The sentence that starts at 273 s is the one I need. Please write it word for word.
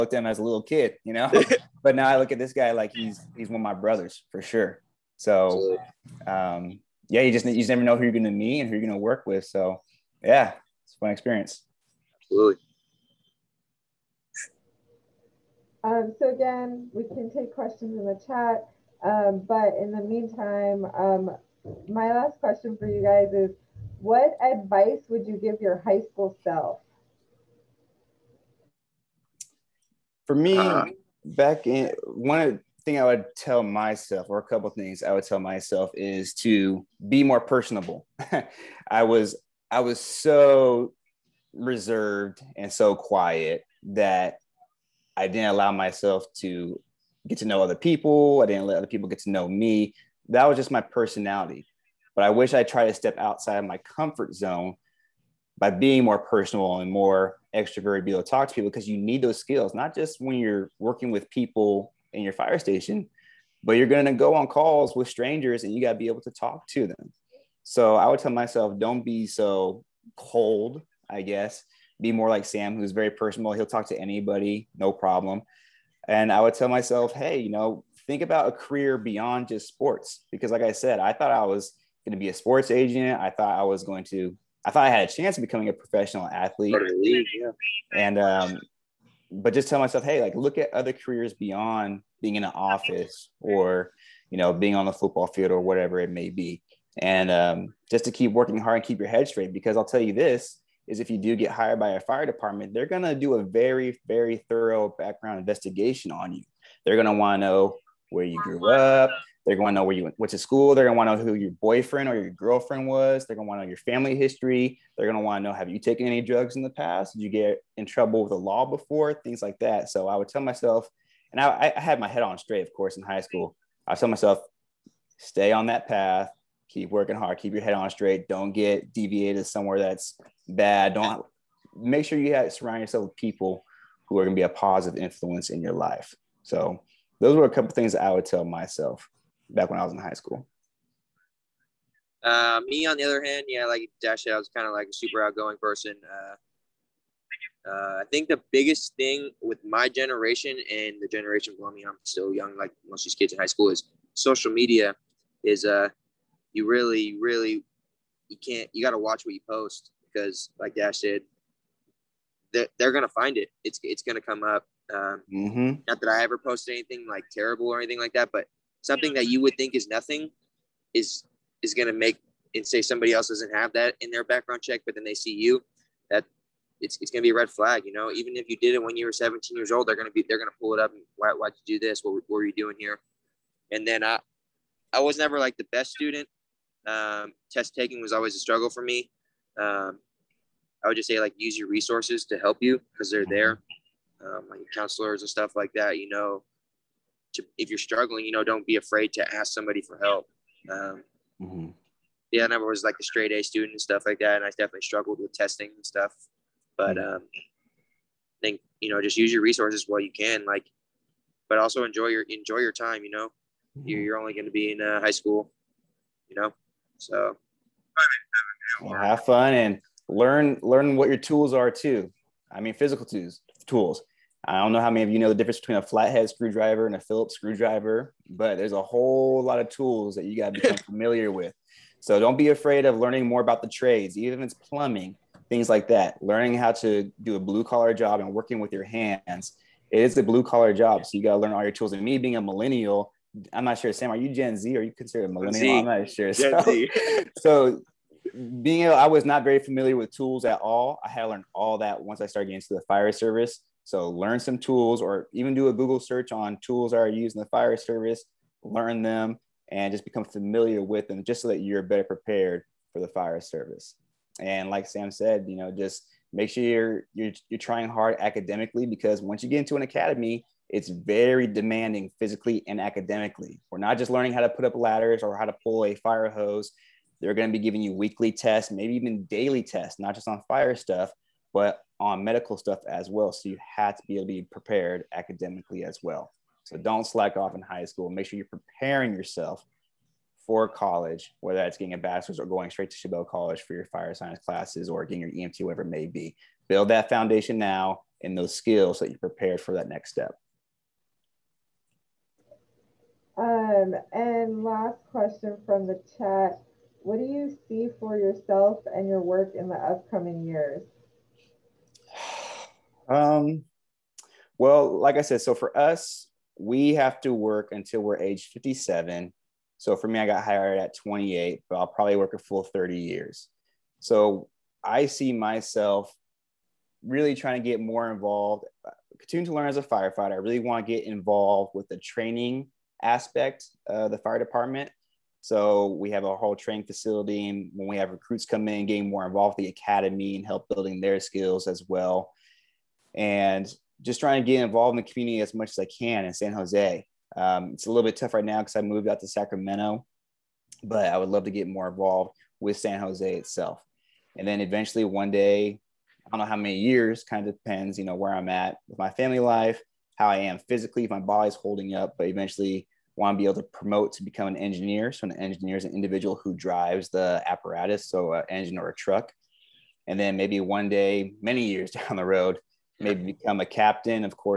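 We're not just learning how to put up ladders or how to pull a fire hose.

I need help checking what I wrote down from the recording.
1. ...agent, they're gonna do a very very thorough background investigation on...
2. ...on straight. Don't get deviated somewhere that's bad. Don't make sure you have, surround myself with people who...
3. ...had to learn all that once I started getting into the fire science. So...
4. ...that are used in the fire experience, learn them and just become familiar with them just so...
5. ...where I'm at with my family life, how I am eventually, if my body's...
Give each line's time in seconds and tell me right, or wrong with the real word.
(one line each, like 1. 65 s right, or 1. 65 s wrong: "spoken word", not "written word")
1. 102 s wrong: "department", not "agent"
2. 127 s wrong: "yourself", not "myself"
3. 251 s wrong: "service", not "science"
4. 256 s wrong: "service", not "experience"
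5. 358 s wrong: "physically", not "eventually".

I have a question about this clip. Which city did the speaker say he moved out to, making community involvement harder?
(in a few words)
Sacramento.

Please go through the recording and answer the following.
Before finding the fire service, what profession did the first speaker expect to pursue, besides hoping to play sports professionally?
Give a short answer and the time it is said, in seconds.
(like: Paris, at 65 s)
Sports agent, at 82 s.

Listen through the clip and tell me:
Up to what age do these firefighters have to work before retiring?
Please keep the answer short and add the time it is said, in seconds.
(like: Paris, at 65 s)
57, at 318 s.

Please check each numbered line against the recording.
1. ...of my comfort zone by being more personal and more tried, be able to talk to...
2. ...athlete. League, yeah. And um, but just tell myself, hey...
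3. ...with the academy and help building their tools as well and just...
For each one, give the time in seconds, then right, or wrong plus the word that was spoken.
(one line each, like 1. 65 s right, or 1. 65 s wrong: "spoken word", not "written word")
1. 53 s wrong: "extroverted", not "tried"
2. 86 s right
3. 339 s wrong: "skills", not "tools".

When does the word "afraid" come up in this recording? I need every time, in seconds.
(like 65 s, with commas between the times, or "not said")
198 s, 232 s.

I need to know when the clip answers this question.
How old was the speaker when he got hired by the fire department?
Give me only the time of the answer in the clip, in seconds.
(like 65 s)
320 s.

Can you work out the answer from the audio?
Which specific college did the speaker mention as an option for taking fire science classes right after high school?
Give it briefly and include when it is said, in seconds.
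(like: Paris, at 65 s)
Chabot College, at 292 s.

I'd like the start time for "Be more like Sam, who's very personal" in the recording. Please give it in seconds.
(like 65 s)
71 s.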